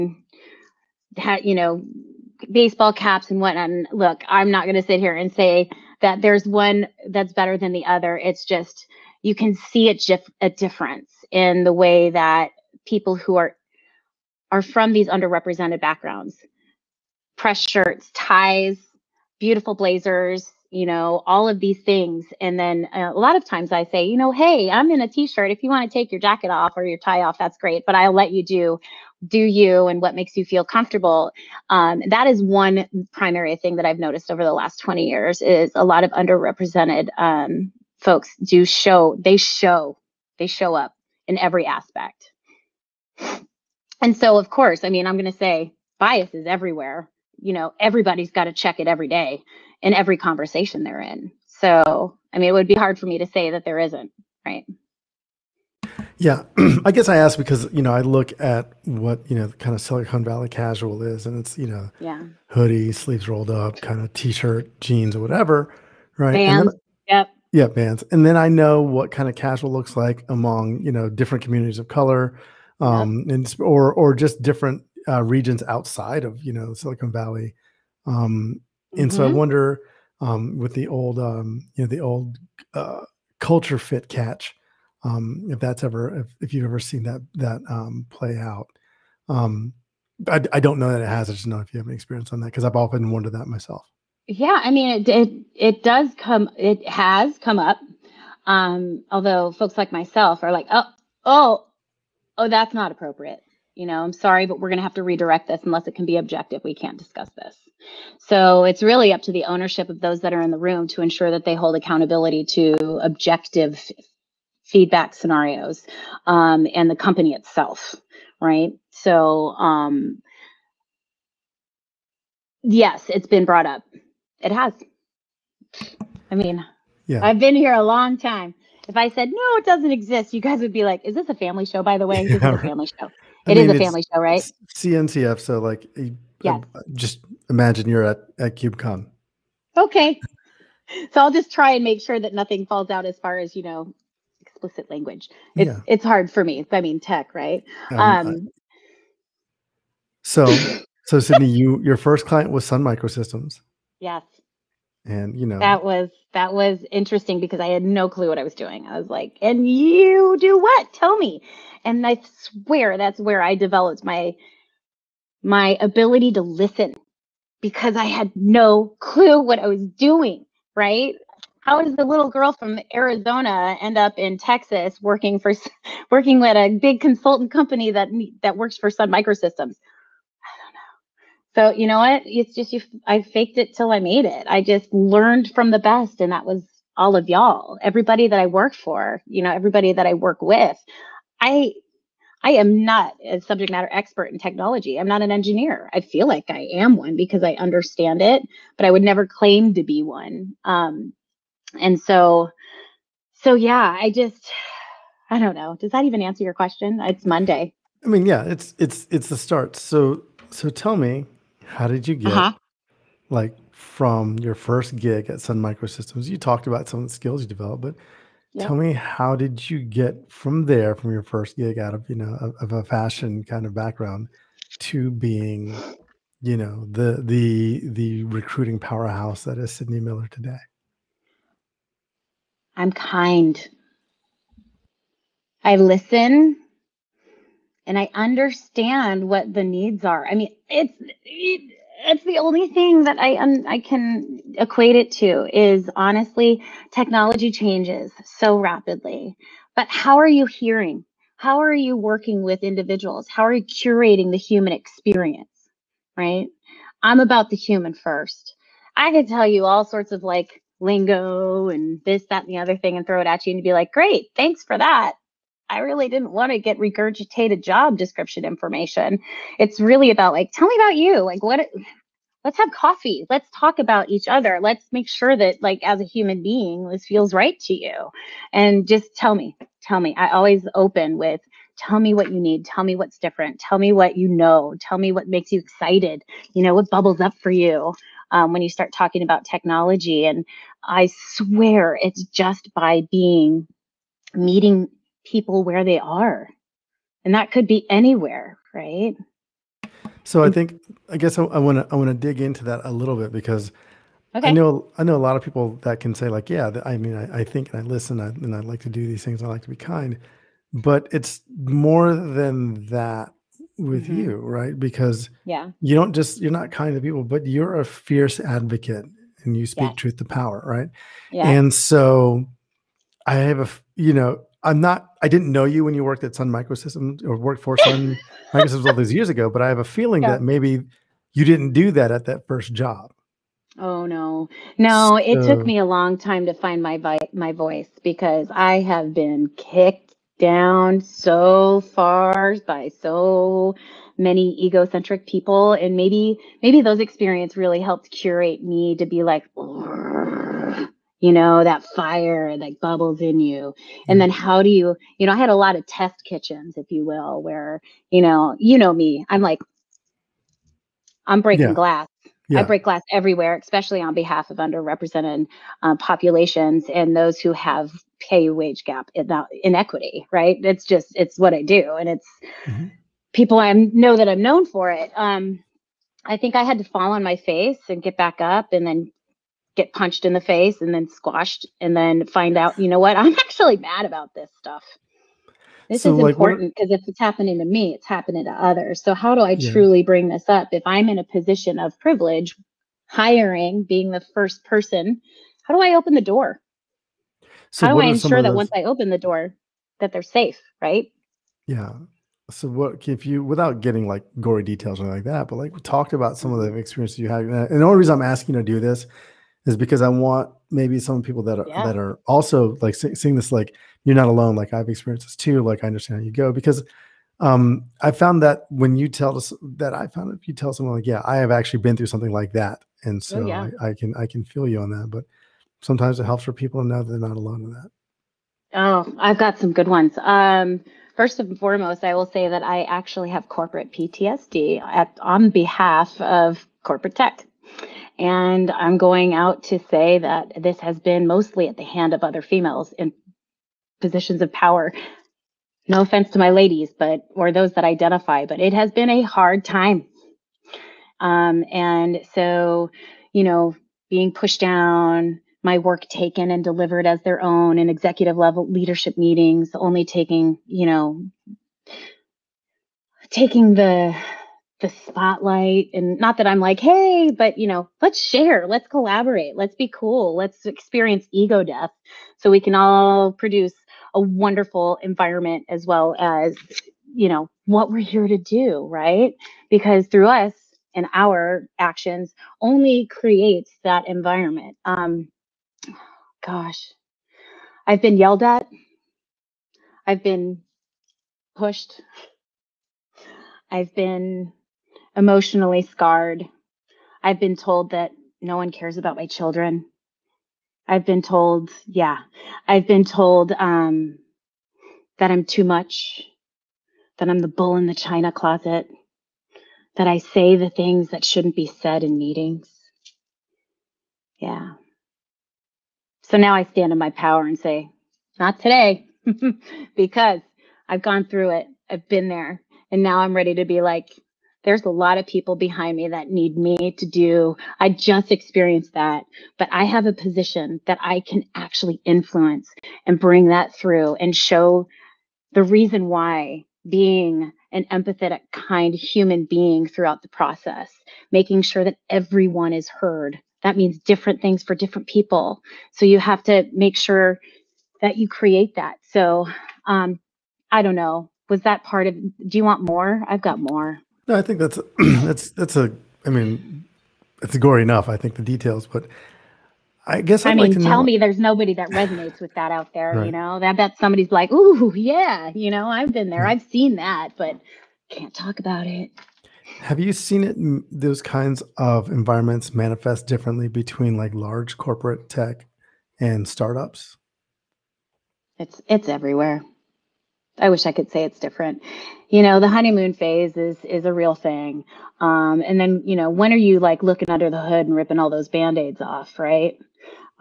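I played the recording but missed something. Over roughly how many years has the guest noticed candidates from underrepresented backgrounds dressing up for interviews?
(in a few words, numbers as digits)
20.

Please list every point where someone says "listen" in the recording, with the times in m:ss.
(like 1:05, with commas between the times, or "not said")
2:46, 3:55, 5:07.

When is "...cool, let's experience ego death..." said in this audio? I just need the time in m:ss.
7:49.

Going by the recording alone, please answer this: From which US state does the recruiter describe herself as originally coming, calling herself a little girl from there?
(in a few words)
Arizona.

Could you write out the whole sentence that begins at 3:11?
I I am not a subject matter expert in technology.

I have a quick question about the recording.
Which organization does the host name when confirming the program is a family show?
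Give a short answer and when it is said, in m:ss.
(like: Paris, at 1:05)
CNCF, at 2:14.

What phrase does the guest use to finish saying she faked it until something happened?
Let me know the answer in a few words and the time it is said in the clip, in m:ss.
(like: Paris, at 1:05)
I made it, at 3:03.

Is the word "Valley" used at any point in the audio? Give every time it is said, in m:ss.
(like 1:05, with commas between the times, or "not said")
1:00, 1:17.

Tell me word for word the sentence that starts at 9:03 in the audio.
That means different things for different people.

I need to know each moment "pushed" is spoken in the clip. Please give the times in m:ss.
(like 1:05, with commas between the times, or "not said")
7:34, 8:11.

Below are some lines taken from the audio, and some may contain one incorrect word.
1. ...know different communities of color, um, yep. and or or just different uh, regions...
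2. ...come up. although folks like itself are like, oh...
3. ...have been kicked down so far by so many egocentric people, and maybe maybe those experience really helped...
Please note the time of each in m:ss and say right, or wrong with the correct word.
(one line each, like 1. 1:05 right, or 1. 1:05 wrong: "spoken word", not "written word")
1. 1:10 right
2. 1:37 wrong: "myself", not "itself"
3. 5:38 right.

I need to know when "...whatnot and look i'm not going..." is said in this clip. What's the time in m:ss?
0:03.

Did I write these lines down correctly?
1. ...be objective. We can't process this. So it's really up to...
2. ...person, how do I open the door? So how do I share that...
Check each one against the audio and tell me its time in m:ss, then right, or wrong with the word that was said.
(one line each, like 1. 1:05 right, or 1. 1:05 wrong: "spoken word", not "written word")
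1. 1:46 wrong: "discuss", not "process"
2. 6:34 wrong: "ensure", not "share".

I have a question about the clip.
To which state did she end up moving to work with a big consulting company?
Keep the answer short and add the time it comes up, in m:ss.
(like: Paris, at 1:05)
Texas, at 2:54.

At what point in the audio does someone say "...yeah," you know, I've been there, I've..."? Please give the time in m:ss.
9:24.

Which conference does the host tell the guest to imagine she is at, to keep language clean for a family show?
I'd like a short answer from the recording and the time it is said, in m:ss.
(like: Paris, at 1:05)
KubeCon, at 2:18.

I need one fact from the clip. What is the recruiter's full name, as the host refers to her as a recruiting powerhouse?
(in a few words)
Sidney Miller.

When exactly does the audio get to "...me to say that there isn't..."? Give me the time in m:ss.
0:53.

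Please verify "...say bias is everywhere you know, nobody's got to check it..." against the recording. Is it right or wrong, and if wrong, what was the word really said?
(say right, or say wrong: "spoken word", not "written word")
wrong: "everybody", not "nobody".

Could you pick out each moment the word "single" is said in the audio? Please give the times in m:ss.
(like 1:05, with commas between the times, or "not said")
not said.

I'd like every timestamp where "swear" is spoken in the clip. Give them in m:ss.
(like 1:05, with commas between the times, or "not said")
2:42, 4:51.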